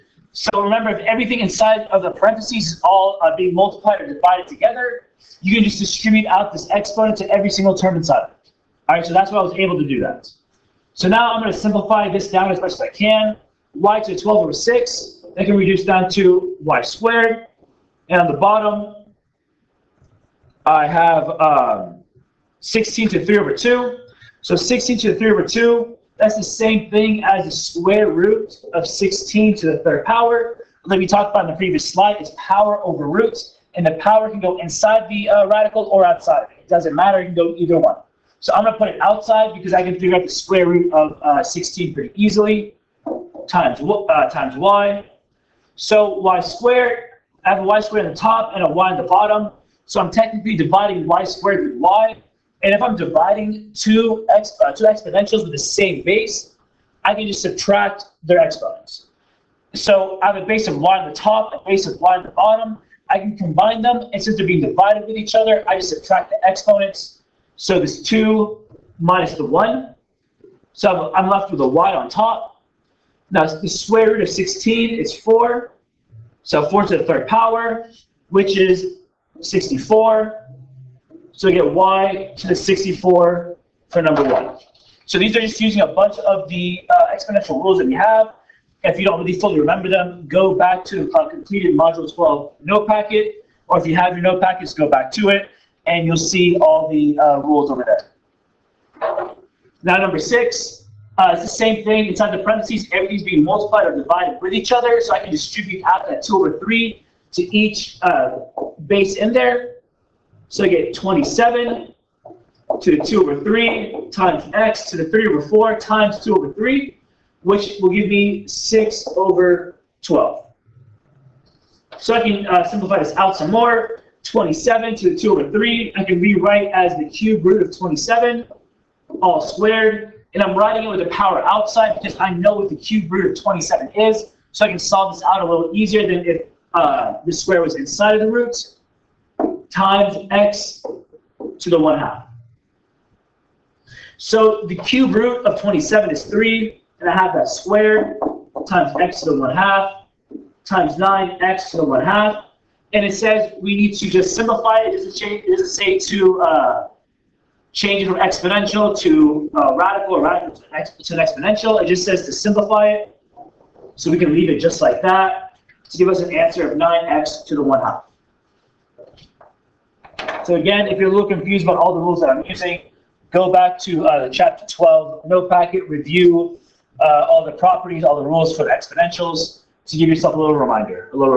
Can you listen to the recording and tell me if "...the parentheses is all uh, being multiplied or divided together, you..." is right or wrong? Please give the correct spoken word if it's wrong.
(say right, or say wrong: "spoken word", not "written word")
right.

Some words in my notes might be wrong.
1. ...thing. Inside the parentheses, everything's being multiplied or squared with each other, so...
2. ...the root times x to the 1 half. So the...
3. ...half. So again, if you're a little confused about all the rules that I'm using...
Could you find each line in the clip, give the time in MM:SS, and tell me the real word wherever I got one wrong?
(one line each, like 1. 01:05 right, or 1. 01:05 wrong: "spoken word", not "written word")
1. 01:41 wrong: "divided", not "squared"
2. 02:18 right
3. 02:47 right.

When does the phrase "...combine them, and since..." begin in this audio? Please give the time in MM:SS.
01:03.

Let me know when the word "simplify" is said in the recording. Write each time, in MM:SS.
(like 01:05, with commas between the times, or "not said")
00:11, 02:02, 02:34, 02:42.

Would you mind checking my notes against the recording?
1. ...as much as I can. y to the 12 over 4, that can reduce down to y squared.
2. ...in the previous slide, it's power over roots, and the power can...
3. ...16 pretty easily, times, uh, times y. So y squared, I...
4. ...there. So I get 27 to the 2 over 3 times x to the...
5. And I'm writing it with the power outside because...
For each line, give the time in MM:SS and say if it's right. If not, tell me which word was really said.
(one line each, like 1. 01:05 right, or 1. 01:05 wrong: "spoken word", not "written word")
1. 00:12 wrong: "6", not "4"
2. 00:31 right
3. 00:41 right
4. 01:49 right
5. 02:10 right.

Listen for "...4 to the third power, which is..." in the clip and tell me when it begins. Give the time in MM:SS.
01:16.